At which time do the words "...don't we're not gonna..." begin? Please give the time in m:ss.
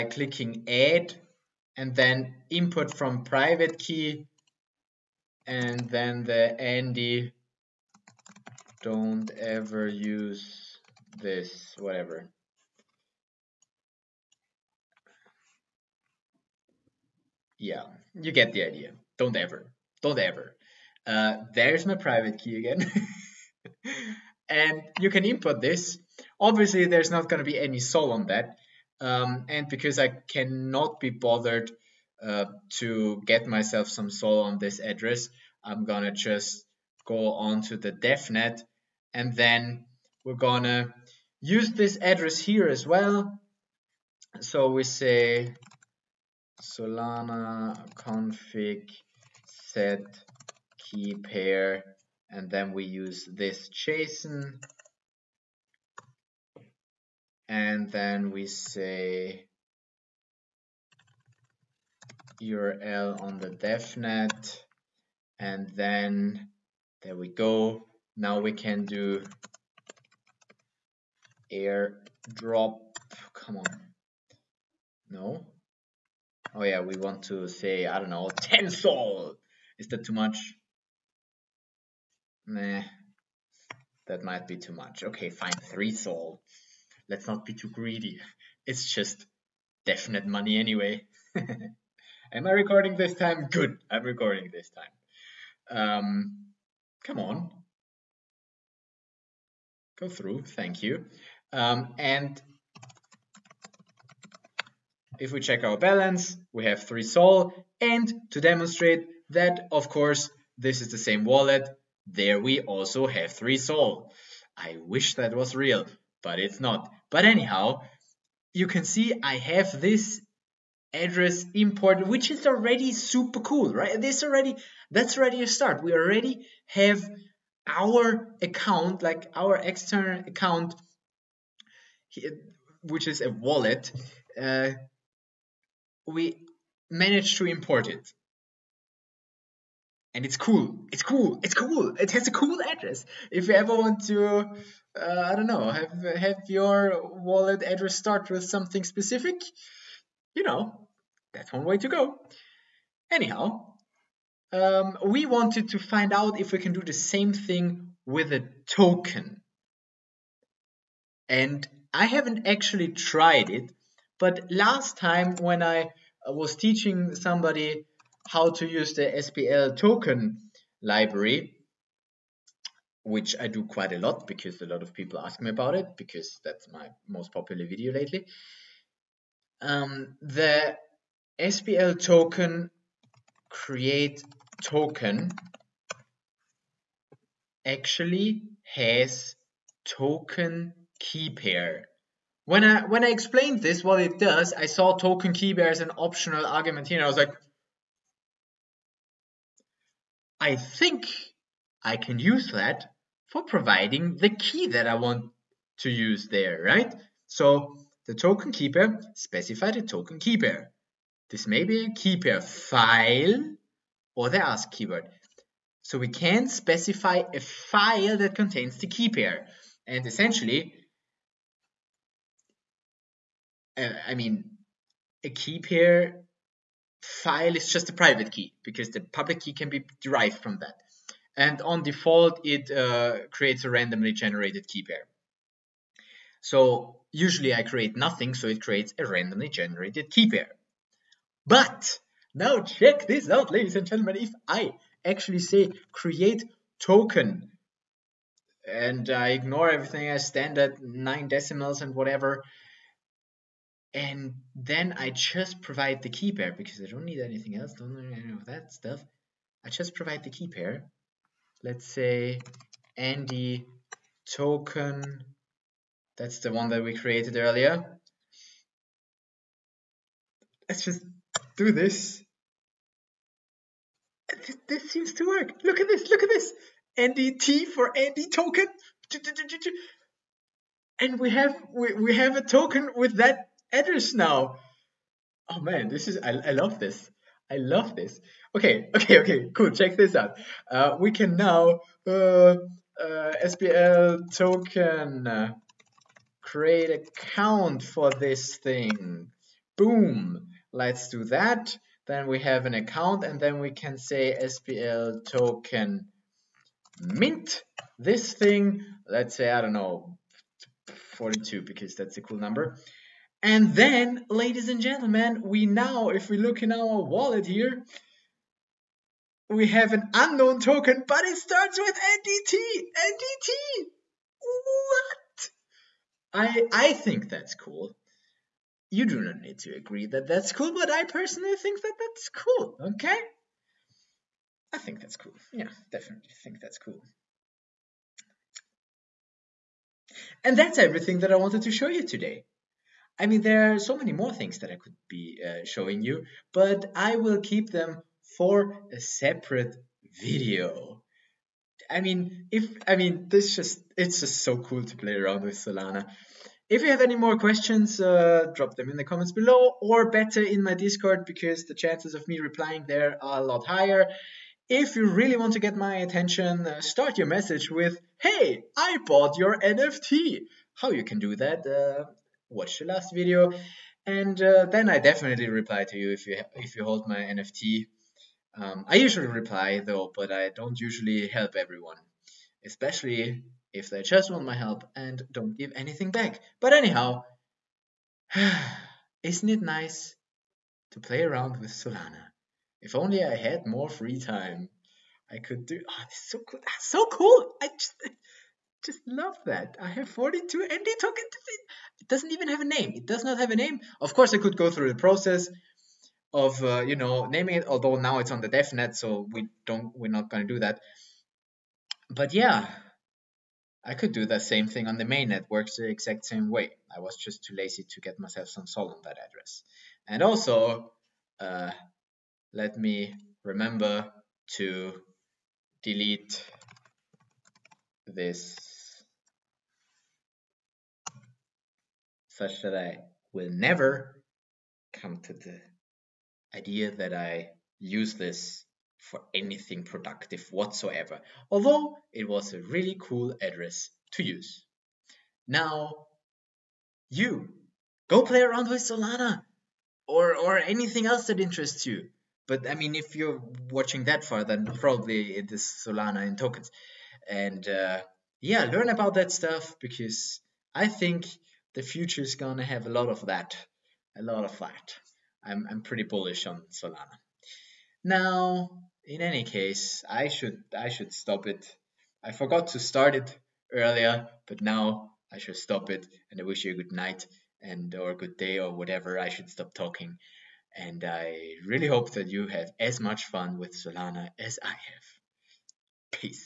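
6:49.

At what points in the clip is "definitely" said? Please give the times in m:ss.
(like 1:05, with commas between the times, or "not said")
5:35, 6:14.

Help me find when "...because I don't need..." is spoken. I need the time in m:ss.
4:16.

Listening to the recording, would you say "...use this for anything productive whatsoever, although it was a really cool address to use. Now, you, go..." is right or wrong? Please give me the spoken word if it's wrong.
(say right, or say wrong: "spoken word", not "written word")
right.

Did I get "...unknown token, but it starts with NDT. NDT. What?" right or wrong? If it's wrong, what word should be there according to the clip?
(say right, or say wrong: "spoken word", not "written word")
right.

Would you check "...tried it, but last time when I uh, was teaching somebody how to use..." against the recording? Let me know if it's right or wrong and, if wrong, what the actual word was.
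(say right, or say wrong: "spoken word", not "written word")
right.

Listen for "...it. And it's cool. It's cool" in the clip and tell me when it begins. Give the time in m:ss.
2:17.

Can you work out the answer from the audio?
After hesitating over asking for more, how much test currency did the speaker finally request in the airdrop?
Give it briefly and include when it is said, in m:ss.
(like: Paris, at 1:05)
3 SOL, at 1:25.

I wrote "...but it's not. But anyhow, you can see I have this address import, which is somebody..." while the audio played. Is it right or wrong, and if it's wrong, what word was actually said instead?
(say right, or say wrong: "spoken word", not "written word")
wrong: "already", not "somebody".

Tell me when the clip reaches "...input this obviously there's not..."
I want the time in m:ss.
0:25.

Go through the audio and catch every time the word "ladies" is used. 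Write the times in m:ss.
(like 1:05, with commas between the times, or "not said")
4:03, 5:14.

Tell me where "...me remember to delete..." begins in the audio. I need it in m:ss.
7:02.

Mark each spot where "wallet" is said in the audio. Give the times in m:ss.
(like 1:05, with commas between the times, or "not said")
1:51, 2:13, 2:27, 5:17.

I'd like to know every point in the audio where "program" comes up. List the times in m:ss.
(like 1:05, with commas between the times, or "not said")
not said.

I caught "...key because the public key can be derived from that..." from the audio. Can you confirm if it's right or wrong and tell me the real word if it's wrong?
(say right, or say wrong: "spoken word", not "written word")
right.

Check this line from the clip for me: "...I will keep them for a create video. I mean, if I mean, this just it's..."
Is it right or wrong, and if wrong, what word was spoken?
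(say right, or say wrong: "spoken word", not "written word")
wrong: "separate", not "create".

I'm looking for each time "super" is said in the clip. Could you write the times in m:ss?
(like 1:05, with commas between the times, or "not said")
2:02.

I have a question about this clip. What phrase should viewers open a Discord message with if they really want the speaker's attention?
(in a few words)
Hey, I bought your NFT.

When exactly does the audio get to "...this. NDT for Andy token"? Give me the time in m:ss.
4:36.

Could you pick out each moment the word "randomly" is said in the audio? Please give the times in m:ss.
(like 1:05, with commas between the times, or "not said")
3:53, 3:59.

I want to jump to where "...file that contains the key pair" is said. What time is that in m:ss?
3:37.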